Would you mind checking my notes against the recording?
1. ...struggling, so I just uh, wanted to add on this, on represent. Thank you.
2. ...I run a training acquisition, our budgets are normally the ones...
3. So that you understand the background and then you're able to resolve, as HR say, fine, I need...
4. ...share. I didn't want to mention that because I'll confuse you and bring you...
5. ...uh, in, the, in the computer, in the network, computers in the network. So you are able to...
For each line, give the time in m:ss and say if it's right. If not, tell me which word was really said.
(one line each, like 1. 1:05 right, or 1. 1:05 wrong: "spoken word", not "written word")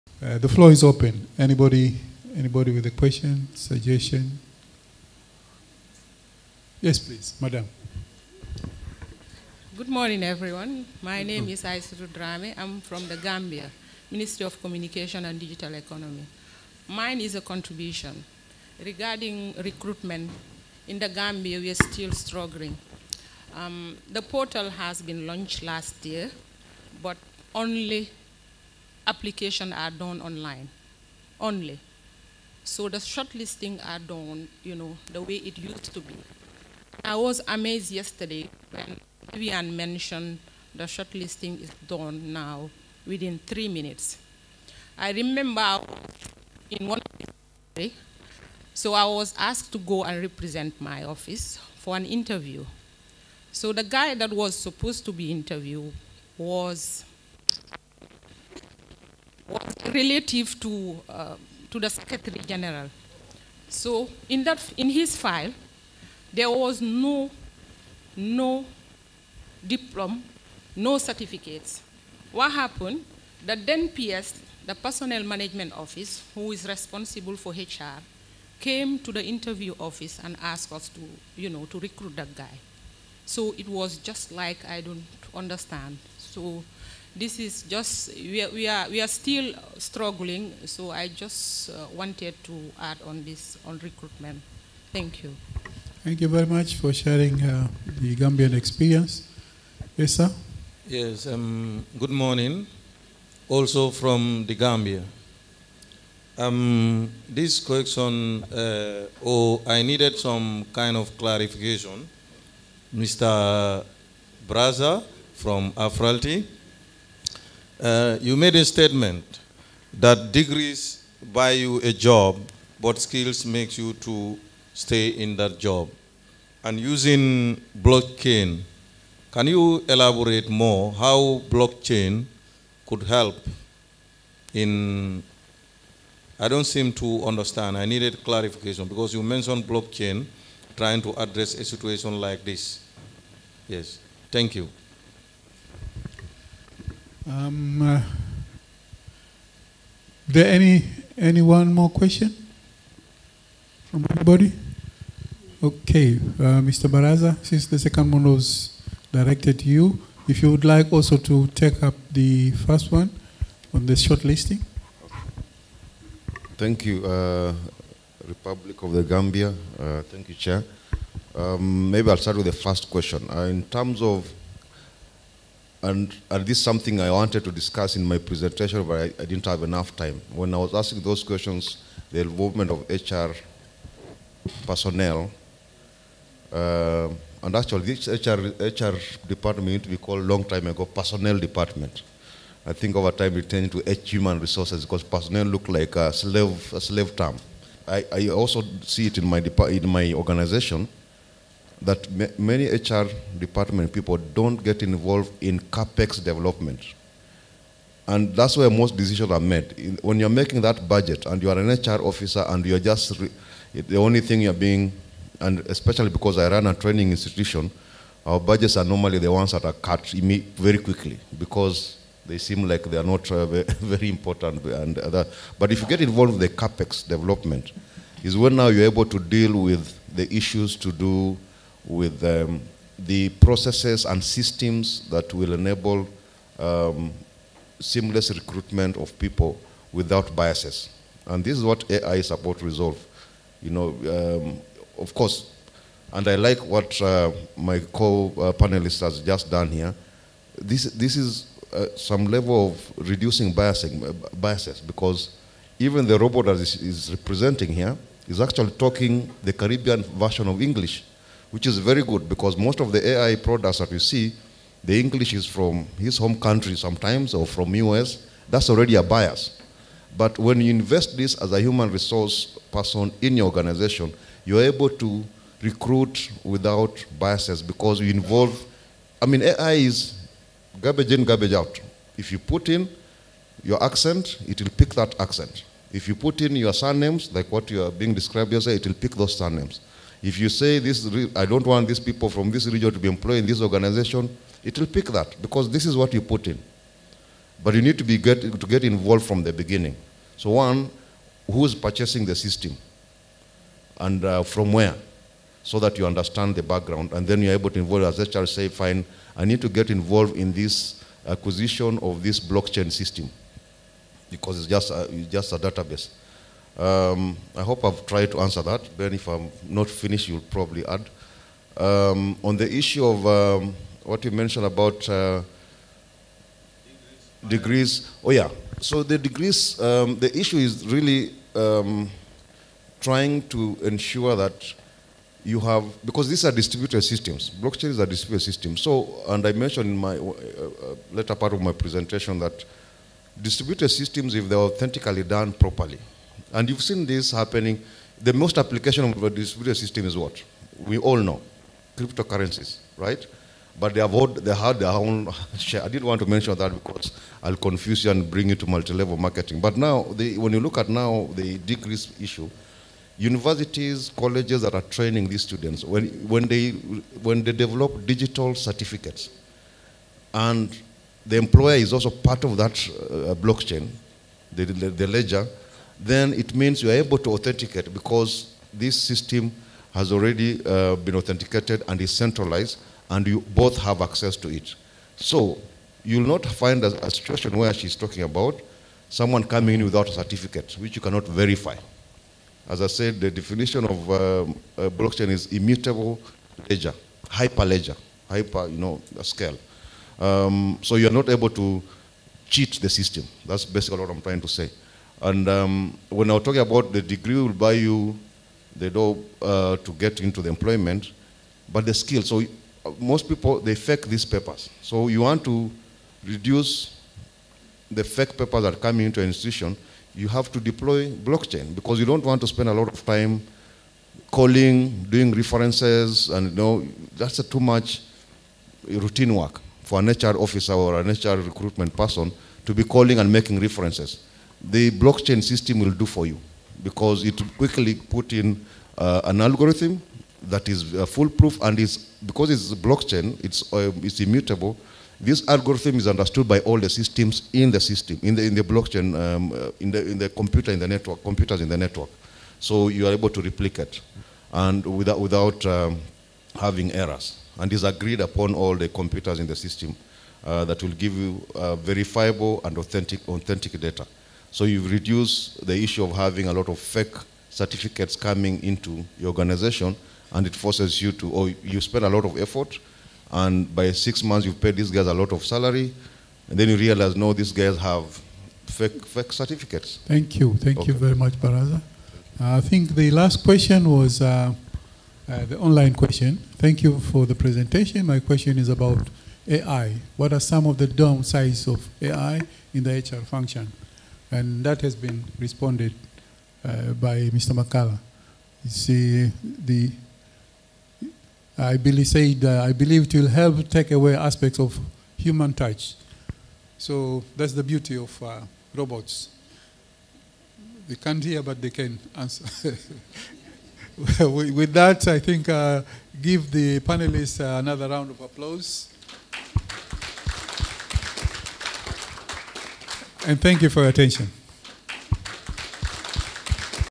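1. 1:29 wrong: "recruitment", not "represent"
2. 3:36 wrong: "institution", not "acquisition"
3. 5:05 wrong: "involve", not "resolve"
4. 5:55 right
5. 7:29 right.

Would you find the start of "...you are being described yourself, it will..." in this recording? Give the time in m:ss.
4:47.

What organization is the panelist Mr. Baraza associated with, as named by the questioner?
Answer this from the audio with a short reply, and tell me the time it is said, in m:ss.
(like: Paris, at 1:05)
Afralti, at 1:55.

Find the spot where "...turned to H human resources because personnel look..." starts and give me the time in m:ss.
3:13.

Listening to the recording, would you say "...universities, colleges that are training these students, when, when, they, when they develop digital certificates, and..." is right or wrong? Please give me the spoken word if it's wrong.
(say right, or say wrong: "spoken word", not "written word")
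right.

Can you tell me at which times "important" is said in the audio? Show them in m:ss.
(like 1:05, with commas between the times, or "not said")
3:44.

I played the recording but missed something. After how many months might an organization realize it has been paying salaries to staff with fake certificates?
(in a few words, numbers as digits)
6.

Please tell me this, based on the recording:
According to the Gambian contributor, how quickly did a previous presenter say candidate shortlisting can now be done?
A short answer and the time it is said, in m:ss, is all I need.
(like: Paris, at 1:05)
within 3 minutes, at 0:43.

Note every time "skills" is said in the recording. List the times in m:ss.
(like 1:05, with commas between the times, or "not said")
2:02, 6:51.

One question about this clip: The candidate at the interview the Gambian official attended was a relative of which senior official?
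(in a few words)
Secretary General.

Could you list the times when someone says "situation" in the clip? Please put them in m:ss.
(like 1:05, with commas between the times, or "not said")
2:21, 6:27.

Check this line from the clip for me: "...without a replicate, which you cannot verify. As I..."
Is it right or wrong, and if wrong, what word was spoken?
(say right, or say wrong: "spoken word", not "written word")
wrong: "certificate", not "replicate".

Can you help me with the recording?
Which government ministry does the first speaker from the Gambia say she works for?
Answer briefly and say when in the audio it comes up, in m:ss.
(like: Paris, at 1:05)
Ministry of Communication and Digital Economy, at 0:14.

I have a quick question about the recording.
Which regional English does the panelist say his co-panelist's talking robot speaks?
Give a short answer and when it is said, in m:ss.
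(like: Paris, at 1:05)
Caribbean, at 4:19.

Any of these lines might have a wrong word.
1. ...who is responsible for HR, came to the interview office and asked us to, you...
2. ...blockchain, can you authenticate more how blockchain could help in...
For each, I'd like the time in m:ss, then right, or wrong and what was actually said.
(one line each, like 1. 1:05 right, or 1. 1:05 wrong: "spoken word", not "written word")
1. 1:16 right
2. 2:07 wrong: "elaborate", not "authenticate".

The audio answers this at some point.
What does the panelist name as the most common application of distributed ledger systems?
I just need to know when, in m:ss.
5:51.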